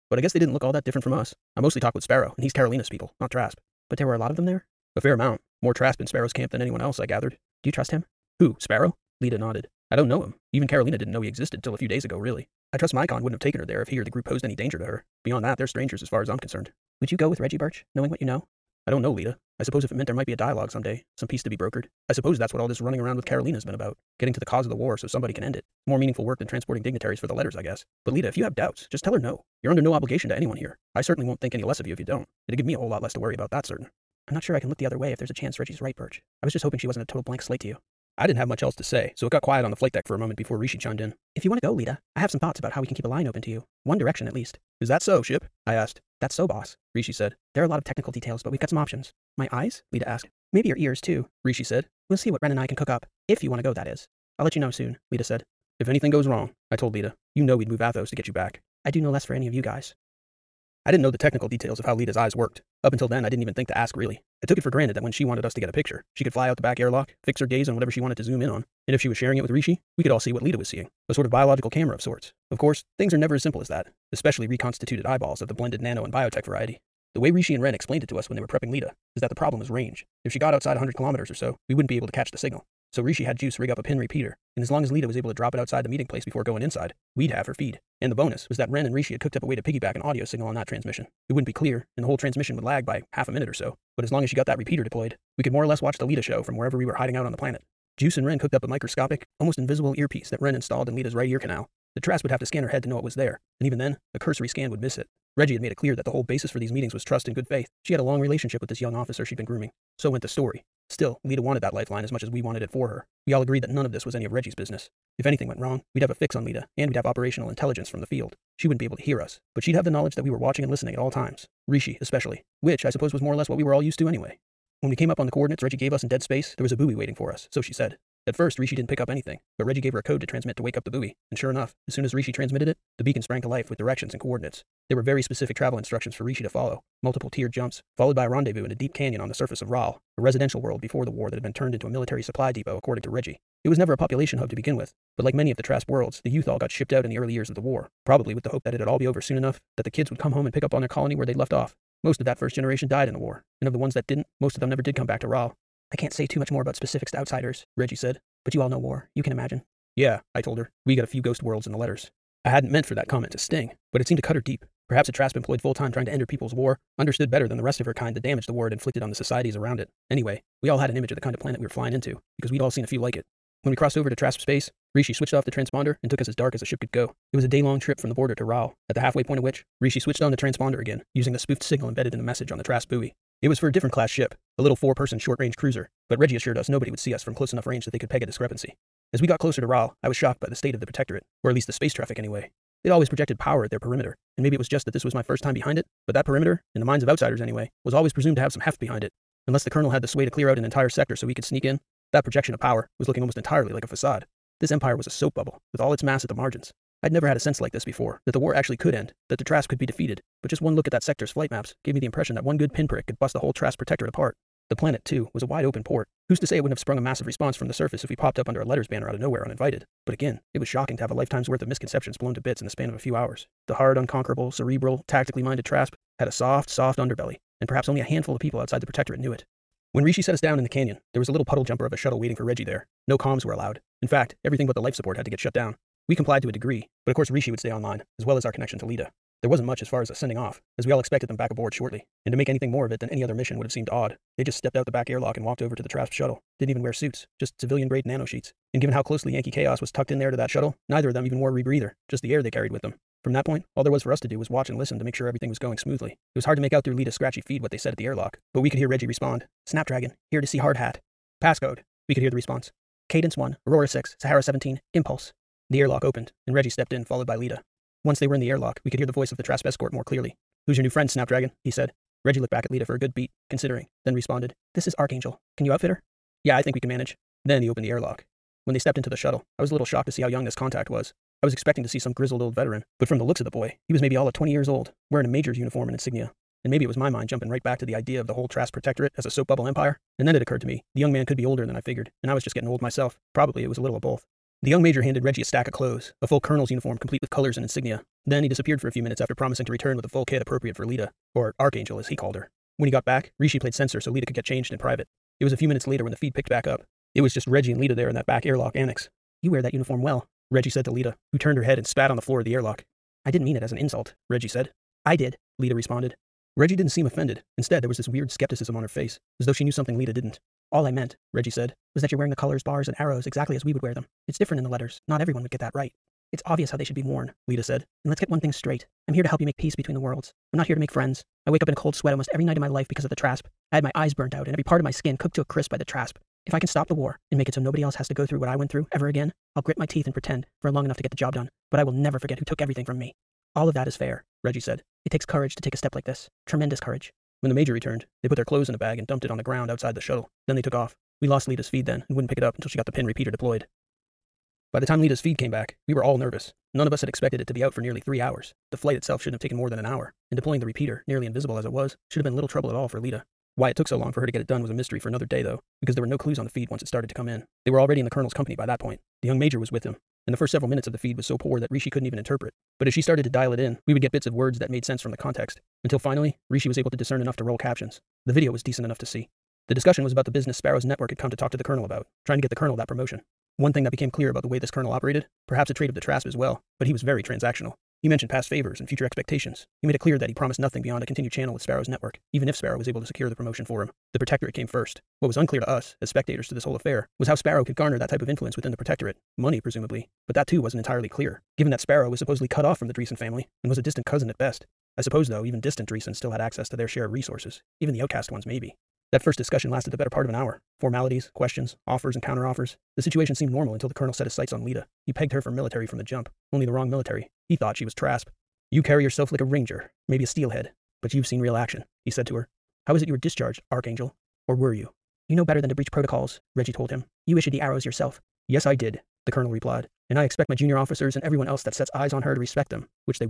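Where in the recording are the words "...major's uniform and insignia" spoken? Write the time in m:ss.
4:45.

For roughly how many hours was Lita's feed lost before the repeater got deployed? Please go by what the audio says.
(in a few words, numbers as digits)
3 hours.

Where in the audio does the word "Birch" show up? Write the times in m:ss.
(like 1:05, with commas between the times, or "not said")
0:17, 0:35.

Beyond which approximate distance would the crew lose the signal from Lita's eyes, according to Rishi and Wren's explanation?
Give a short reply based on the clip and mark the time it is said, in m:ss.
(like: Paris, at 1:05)
100 kilometers, at 1:20.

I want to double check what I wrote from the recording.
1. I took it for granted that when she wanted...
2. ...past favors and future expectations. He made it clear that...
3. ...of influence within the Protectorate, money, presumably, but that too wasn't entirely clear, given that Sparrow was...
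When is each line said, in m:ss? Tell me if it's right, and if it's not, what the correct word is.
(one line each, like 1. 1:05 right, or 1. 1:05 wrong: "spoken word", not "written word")
1. 1:04 right
2. 6:28 right
3. 6:38 right.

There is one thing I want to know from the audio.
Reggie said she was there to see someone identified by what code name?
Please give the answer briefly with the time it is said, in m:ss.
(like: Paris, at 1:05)
Hard Hat, at 4:20.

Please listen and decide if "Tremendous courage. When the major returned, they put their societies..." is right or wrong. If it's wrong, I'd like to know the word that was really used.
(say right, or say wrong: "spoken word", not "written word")
wrong: "clothes", not "societies".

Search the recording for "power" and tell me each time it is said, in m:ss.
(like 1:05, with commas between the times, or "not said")
3:13, 3:22.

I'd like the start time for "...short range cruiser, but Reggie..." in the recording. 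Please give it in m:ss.
3:05.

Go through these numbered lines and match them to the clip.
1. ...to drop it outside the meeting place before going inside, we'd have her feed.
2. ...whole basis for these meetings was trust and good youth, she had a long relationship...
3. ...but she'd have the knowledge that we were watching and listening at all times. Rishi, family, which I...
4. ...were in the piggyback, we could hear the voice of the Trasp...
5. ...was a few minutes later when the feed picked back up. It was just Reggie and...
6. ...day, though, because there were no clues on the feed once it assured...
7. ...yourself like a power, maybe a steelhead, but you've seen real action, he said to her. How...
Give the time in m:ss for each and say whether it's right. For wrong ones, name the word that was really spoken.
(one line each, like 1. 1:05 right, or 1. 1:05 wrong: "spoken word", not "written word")
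1. 1:25 right
2. 1:46 wrong: "faith", not "youth"
3. 1:59 wrong: "especially", not "family"
4. 4:28 wrong: "airlock", not "piggyback"
5. 5:05 right
6. 6:05 wrong: "started", not "assured"
7. 6:59 wrong: "ranger", not "power".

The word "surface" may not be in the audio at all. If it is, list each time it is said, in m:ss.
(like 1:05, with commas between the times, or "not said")
2:19, 3:37.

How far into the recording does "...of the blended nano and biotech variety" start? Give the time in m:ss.
1:15.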